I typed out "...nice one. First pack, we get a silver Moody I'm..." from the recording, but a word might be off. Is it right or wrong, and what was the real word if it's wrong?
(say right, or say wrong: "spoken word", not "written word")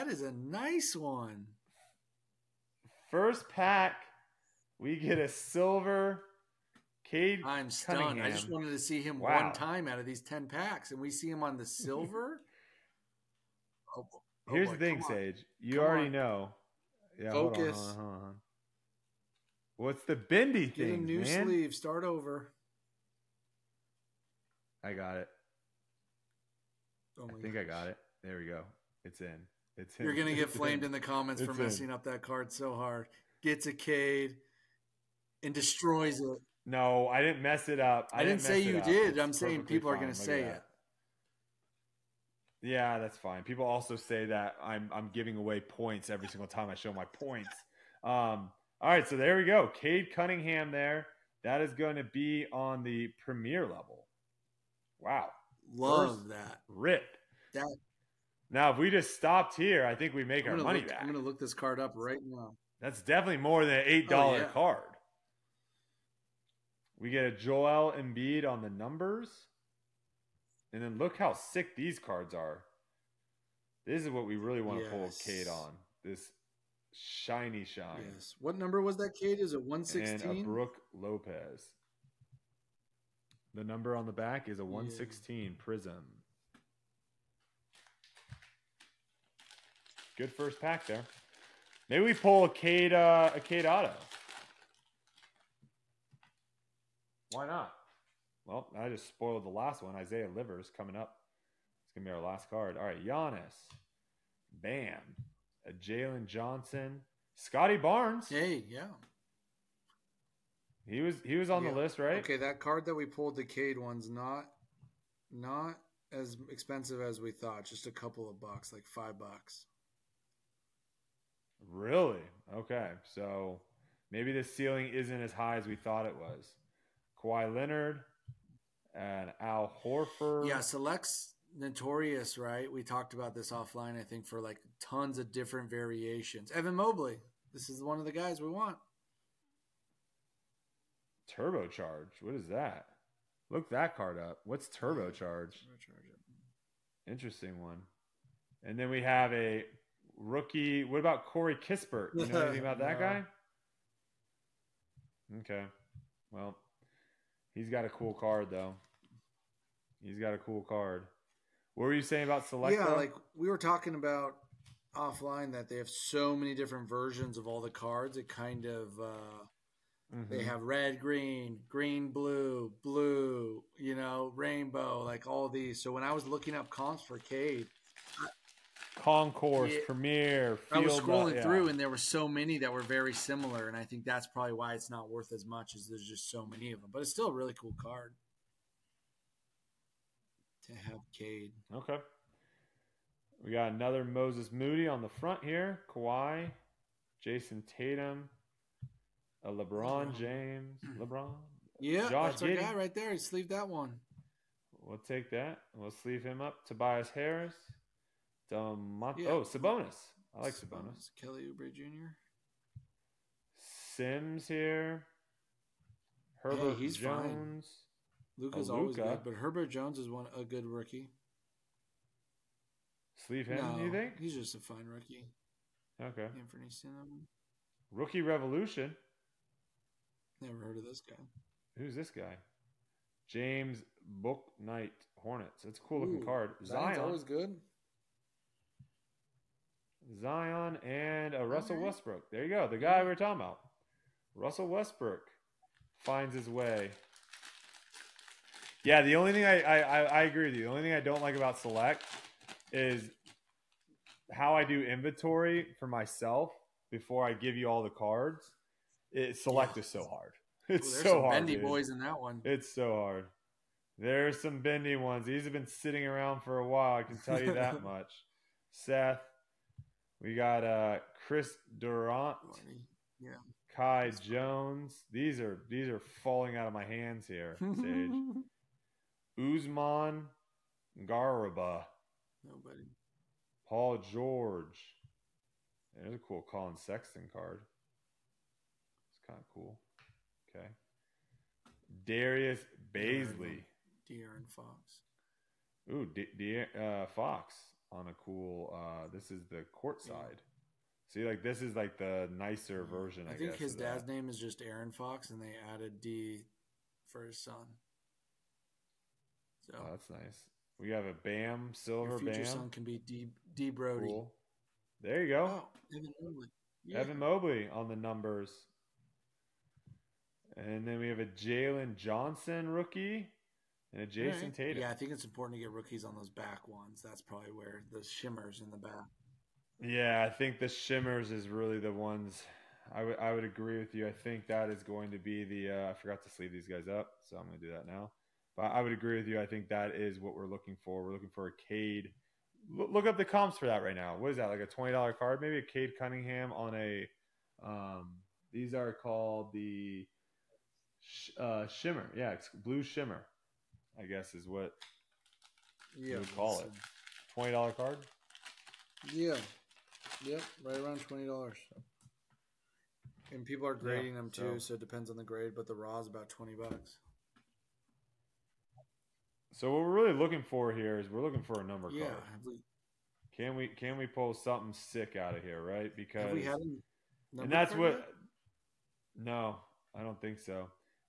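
wrong: "Cade", not "Moody".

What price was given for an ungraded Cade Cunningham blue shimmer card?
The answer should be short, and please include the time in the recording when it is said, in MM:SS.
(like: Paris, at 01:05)
20 dollars, at 06:06.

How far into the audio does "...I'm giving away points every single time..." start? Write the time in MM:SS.
00:44.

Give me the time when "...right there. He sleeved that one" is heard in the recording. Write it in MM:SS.
03:22.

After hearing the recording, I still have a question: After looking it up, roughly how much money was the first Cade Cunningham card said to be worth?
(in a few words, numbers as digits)
5 dollars.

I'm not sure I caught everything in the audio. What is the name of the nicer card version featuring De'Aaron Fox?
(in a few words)
Court side.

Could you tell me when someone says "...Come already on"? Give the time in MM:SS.
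00:15.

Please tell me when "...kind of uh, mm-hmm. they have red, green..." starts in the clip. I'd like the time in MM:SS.
02:48.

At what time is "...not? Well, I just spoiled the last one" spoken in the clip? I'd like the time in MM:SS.
01:37.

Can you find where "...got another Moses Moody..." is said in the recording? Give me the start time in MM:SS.
03:13.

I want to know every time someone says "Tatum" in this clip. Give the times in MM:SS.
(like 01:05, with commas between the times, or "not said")
03:17, 05:24.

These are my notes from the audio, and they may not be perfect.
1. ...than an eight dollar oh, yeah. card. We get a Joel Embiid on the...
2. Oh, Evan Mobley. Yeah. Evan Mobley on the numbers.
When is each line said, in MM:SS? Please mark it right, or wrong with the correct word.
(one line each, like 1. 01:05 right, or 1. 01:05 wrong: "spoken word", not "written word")
1. 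01:03 right
2. 05:15 right.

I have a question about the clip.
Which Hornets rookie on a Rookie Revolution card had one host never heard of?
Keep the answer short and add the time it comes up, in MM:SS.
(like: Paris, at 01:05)
James Bouknight, at 03:53.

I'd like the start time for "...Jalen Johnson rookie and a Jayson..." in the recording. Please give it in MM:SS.
05:21.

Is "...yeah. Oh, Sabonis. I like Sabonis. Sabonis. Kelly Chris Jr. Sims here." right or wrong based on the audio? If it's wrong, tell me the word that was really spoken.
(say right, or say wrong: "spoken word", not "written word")
wrong: "Oubre", not "Chris".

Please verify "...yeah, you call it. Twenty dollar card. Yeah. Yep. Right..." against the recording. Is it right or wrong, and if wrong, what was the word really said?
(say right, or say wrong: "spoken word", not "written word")
right.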